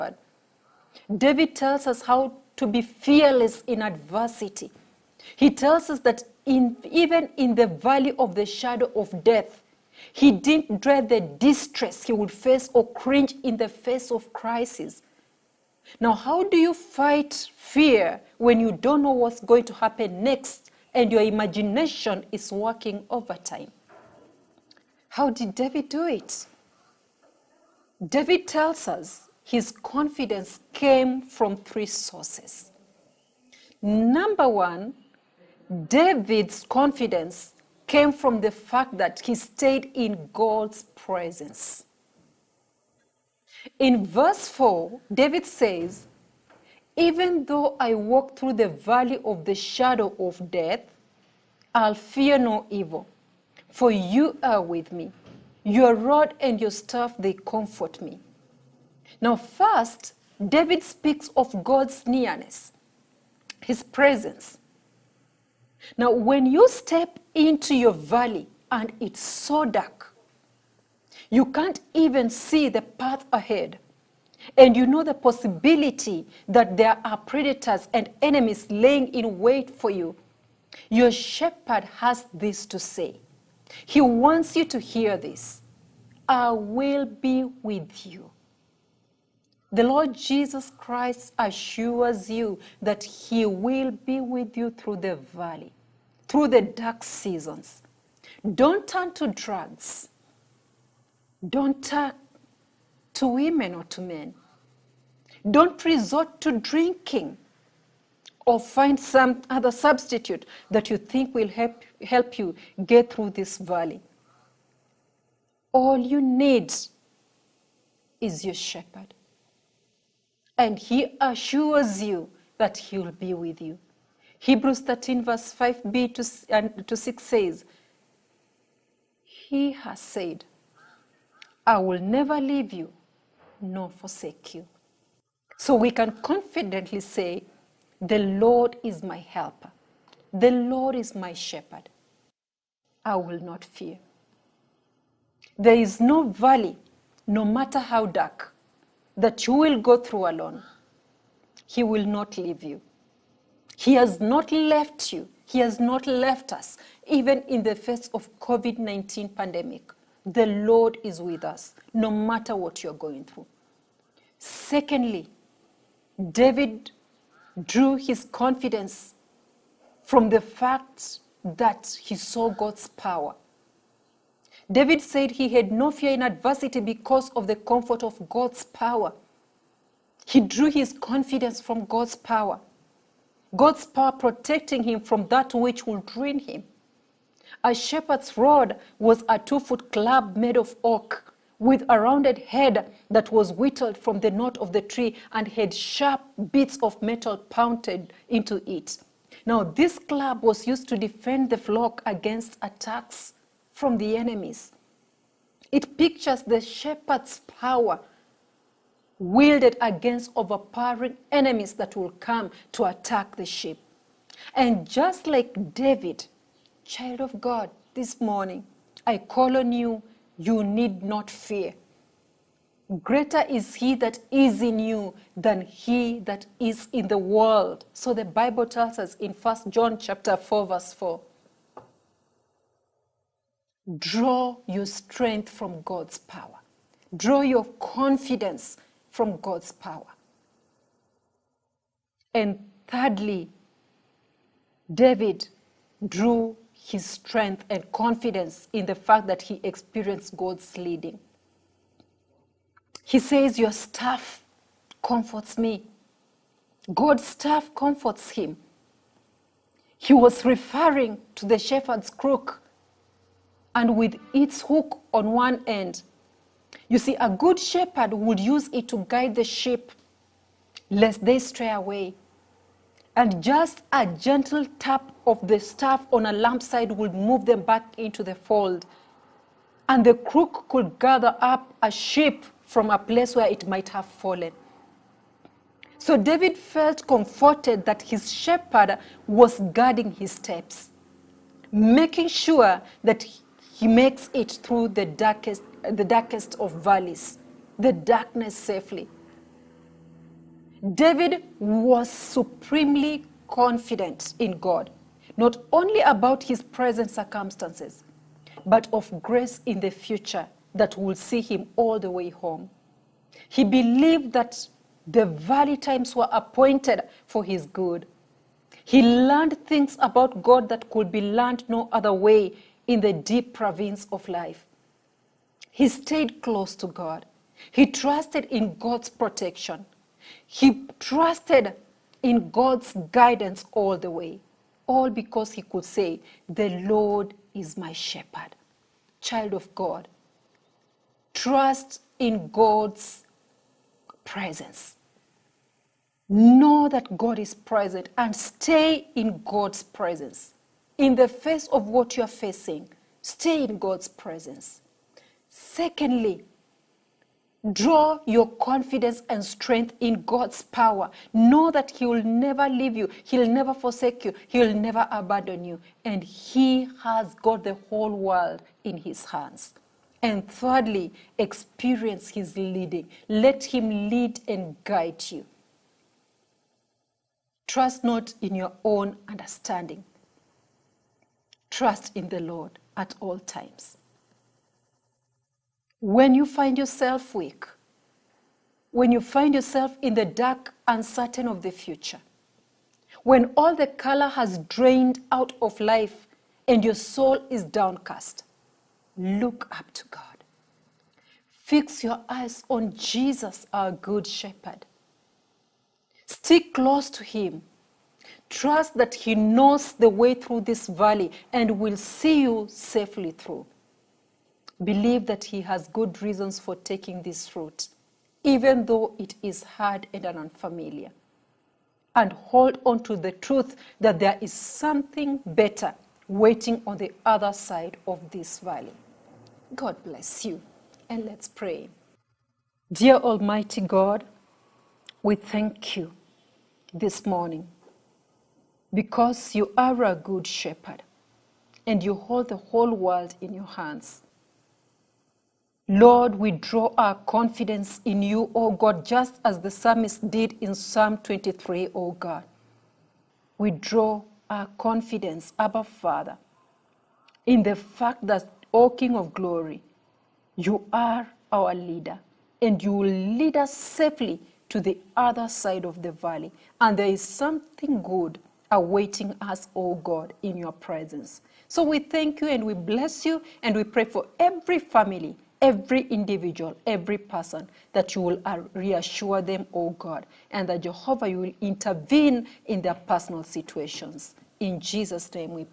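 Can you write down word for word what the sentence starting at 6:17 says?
Trust not in your own understanding, trust in the Lord at all times.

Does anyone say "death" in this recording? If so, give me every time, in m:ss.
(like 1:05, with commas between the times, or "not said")
0:09, 0:50.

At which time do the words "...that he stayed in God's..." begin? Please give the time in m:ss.
0:38.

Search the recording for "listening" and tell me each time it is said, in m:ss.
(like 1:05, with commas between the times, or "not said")
not said.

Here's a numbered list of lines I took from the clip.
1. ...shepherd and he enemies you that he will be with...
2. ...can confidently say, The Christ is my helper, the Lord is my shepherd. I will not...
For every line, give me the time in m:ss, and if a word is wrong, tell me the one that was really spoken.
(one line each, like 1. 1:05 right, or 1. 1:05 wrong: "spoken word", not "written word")
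1. 1:58 wrong: "assures", not "enemies"
2. 2:15 wrong: "Lord", not "Christ".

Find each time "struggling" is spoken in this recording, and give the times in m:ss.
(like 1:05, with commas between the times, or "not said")
not said.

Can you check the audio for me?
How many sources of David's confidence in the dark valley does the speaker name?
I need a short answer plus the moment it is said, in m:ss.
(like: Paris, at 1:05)
3, at 0:31.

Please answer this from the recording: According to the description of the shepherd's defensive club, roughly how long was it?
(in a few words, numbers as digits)
2 foot.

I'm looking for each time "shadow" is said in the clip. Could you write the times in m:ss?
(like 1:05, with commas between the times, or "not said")
0:08, 0:49.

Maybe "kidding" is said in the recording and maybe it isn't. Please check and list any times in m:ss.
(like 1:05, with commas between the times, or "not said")
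not said.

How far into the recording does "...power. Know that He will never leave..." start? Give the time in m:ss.
6:00.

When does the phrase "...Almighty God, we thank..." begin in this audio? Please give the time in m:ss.
7:13.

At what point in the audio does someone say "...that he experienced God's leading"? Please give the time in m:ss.
4:09.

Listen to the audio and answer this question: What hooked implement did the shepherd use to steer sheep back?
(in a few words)
Shepherd's crook.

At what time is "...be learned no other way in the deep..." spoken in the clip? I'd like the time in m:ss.
5:21.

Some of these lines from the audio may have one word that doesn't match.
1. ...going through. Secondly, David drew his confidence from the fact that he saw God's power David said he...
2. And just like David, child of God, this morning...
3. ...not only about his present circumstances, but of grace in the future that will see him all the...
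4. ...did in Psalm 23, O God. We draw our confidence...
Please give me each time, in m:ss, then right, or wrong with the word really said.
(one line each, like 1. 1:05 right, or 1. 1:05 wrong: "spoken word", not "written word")
1. 2:42 right
2. 3:34 right
3. 5:05 right
4. 7:30 right.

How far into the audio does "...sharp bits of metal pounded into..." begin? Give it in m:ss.
3:15.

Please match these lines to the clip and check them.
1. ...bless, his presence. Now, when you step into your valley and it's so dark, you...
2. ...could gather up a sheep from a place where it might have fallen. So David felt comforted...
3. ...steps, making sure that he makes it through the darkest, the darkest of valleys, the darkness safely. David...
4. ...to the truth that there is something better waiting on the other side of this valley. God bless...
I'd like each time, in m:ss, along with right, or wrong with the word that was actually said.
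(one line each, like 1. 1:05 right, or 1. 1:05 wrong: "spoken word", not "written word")
1. 1:02 wrong: "nearness", not "bless"
2. 4:40 right
3. 4:50 right
4. 7:03 right.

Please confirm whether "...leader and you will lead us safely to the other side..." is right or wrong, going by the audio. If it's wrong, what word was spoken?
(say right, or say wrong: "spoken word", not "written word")
right.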